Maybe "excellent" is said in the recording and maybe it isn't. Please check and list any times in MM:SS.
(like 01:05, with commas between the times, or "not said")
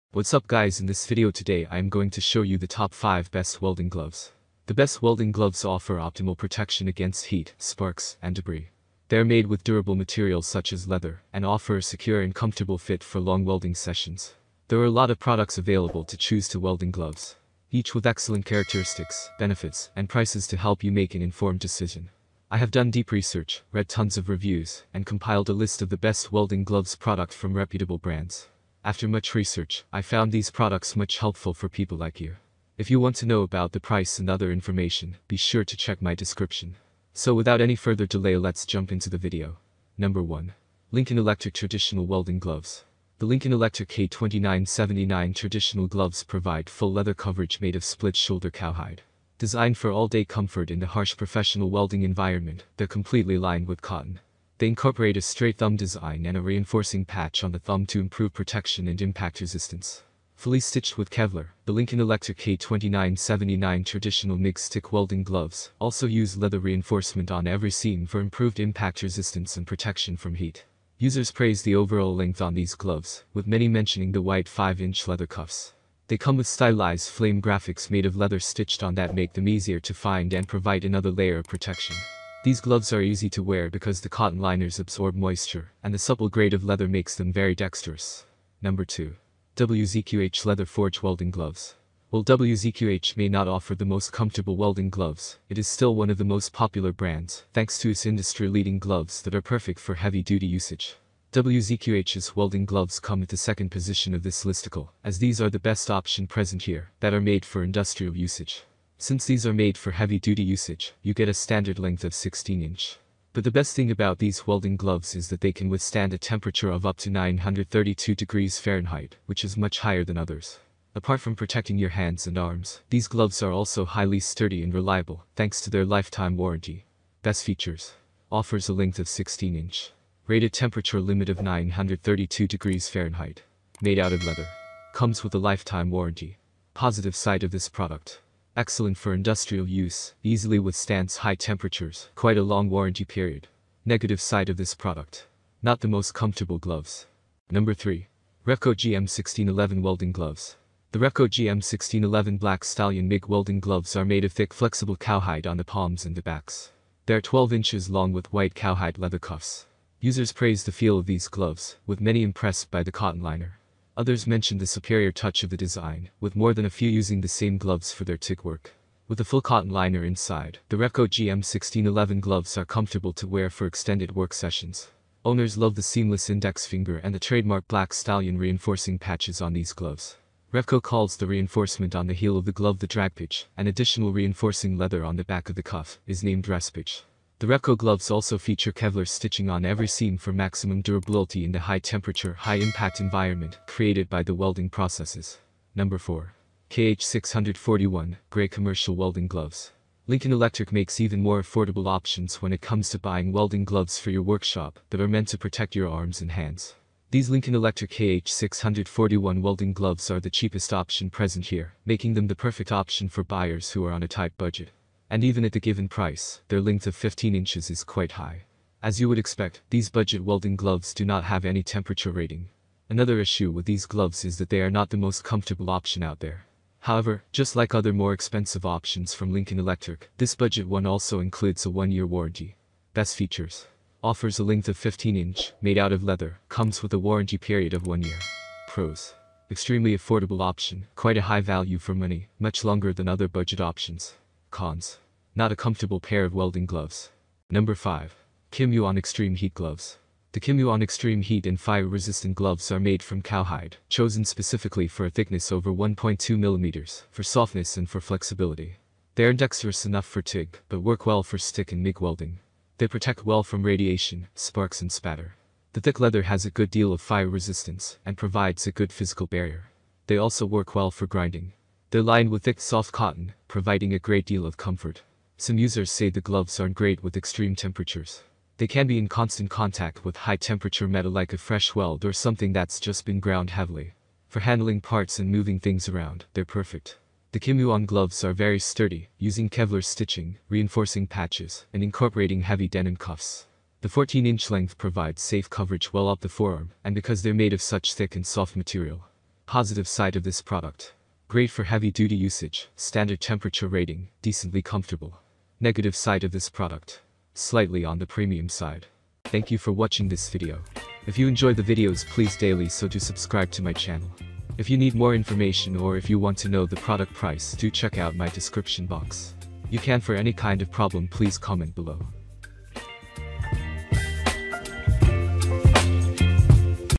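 00:18, 02:18.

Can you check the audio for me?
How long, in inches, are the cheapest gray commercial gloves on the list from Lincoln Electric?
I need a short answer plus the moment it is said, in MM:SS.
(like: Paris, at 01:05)
15 inches, at 03:36.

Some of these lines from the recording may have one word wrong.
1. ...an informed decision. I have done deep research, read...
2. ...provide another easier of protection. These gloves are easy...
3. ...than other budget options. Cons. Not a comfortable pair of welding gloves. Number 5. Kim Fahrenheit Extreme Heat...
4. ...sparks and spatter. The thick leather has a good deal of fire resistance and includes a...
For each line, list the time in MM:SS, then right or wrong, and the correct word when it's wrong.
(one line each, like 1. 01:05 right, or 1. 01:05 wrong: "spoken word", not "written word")
1. 00:21 right
2. 01:20 wrong: "layer", not "easier"
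3. 04:02 wrong: "Yuan", not "Fahrenheit"
4. 04:24 wrong: "provides", not "includes".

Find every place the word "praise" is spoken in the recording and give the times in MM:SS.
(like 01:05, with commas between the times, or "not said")
01:11, 02:40.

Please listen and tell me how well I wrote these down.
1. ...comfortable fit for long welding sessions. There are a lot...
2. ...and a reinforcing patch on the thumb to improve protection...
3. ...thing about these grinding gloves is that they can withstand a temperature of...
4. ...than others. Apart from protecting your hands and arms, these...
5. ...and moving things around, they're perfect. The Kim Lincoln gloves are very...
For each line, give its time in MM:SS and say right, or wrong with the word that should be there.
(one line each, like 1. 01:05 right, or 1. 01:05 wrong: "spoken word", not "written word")
1. 00:12 right
2. 00:56 right
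3. 01:53 wrong: "welding", not "grinding"
4. 02:00 right
5. 04:45 wrong: "Yuan", not "Lincoln".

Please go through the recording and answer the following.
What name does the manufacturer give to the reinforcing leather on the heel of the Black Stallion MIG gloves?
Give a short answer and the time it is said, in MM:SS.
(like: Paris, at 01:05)
drag pitch, at 03:02.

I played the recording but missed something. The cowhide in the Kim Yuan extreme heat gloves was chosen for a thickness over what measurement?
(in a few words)
1.2 millimeters.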